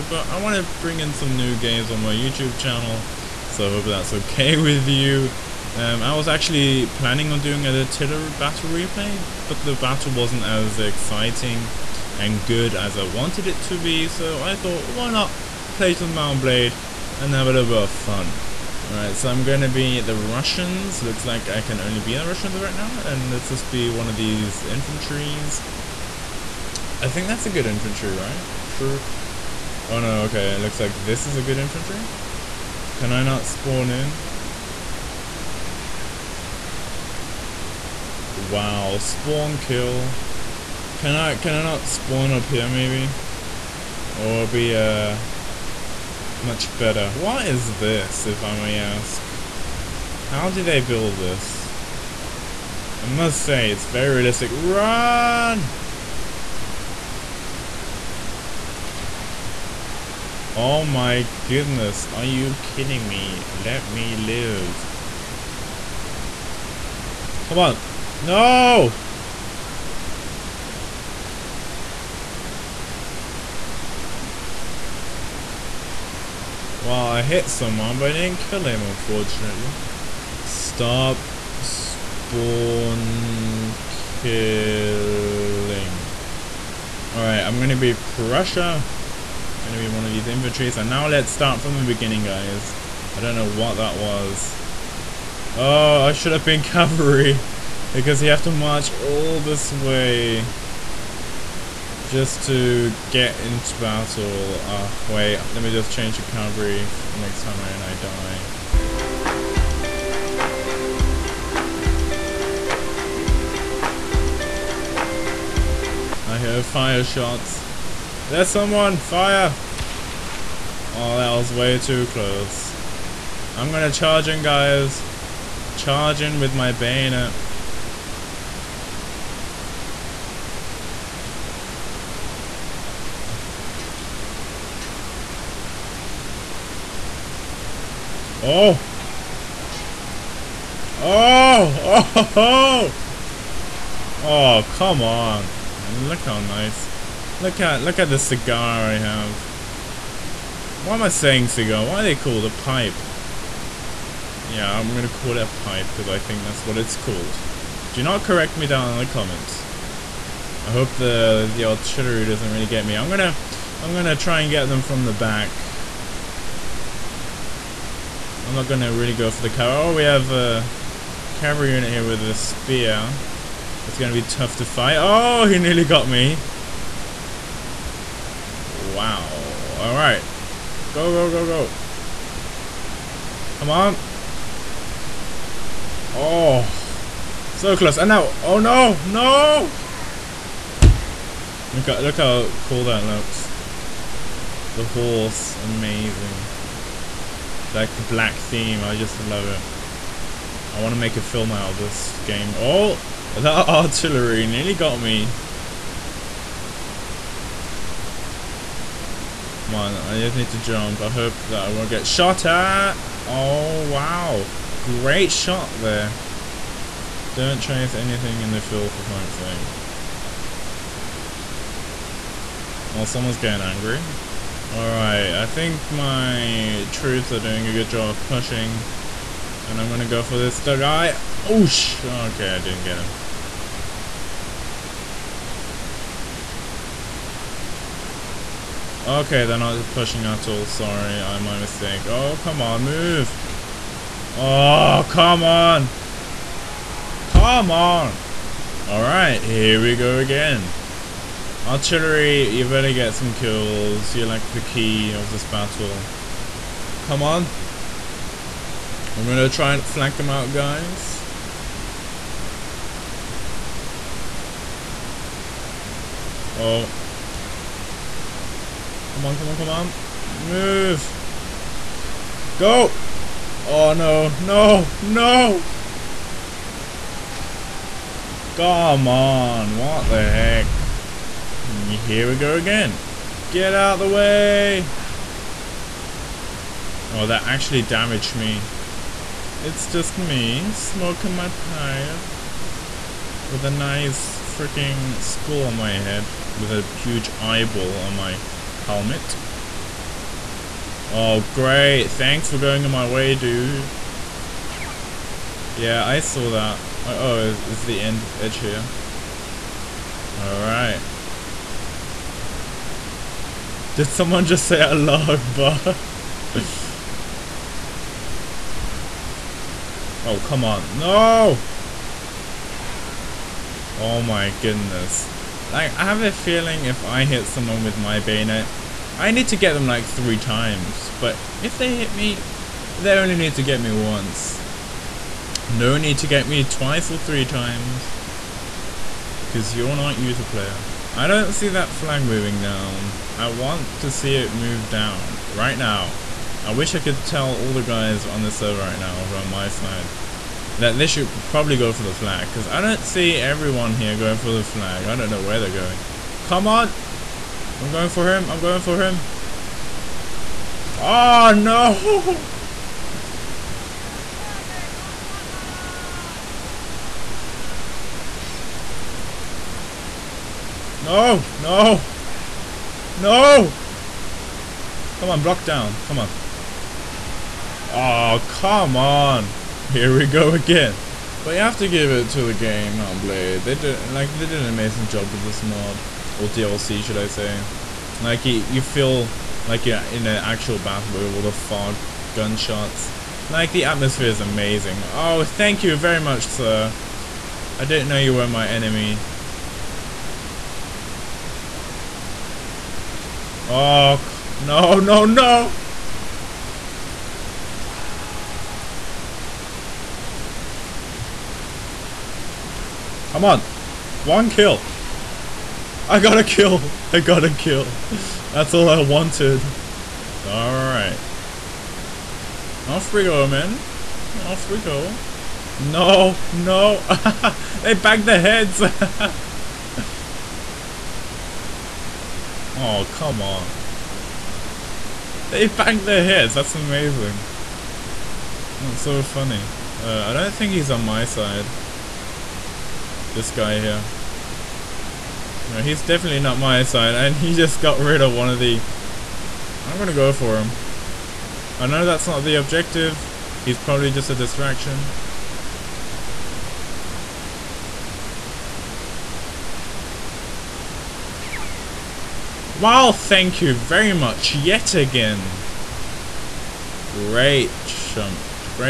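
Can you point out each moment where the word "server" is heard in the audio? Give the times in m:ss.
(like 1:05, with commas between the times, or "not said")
5:48.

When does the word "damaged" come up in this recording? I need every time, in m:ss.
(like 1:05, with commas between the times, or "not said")
4:47.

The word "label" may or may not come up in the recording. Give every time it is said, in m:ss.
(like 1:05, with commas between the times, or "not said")
not said.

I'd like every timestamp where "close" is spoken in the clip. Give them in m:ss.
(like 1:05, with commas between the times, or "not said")
2:02, 3:07.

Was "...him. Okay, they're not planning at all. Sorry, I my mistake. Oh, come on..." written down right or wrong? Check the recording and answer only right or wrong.
wrong.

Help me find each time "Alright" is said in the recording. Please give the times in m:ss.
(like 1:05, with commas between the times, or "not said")
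0:18, 1:27, 2:59, 3:44, 5:10, 7:00.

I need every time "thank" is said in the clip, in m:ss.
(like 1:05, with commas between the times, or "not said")
5:02, 6:35, 7:43.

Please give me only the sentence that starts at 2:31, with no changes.
Why are they called a pipe?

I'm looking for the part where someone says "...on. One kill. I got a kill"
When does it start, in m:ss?
6:53.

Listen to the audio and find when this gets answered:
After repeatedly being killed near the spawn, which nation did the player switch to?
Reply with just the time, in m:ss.
1:27.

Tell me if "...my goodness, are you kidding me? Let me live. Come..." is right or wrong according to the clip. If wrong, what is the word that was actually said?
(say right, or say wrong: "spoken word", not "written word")
right.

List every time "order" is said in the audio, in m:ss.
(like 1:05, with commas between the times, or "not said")
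not said.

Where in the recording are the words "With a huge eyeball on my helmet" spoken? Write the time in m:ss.
4:56.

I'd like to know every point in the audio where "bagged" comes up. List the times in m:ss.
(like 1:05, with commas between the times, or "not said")
7:07.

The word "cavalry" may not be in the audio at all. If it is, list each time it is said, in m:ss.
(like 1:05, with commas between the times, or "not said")
1:36, 1:46, 2:51.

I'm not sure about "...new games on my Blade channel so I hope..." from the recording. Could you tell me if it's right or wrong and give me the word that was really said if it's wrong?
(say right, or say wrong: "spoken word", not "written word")
wrong: "YouTube", not "Blade".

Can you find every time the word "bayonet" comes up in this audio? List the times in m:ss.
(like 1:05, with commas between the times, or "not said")
2:06, 5:28.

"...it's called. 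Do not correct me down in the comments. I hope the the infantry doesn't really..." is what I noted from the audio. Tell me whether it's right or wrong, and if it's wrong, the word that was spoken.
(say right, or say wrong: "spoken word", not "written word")
wrong: "artillery", not "infantry".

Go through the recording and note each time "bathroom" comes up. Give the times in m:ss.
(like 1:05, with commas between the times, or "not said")
not said.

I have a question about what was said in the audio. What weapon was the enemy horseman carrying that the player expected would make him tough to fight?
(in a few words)
Spear.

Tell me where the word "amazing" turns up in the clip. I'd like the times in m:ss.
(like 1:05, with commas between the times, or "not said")
3:15, 6:24, 6:34, 7:16.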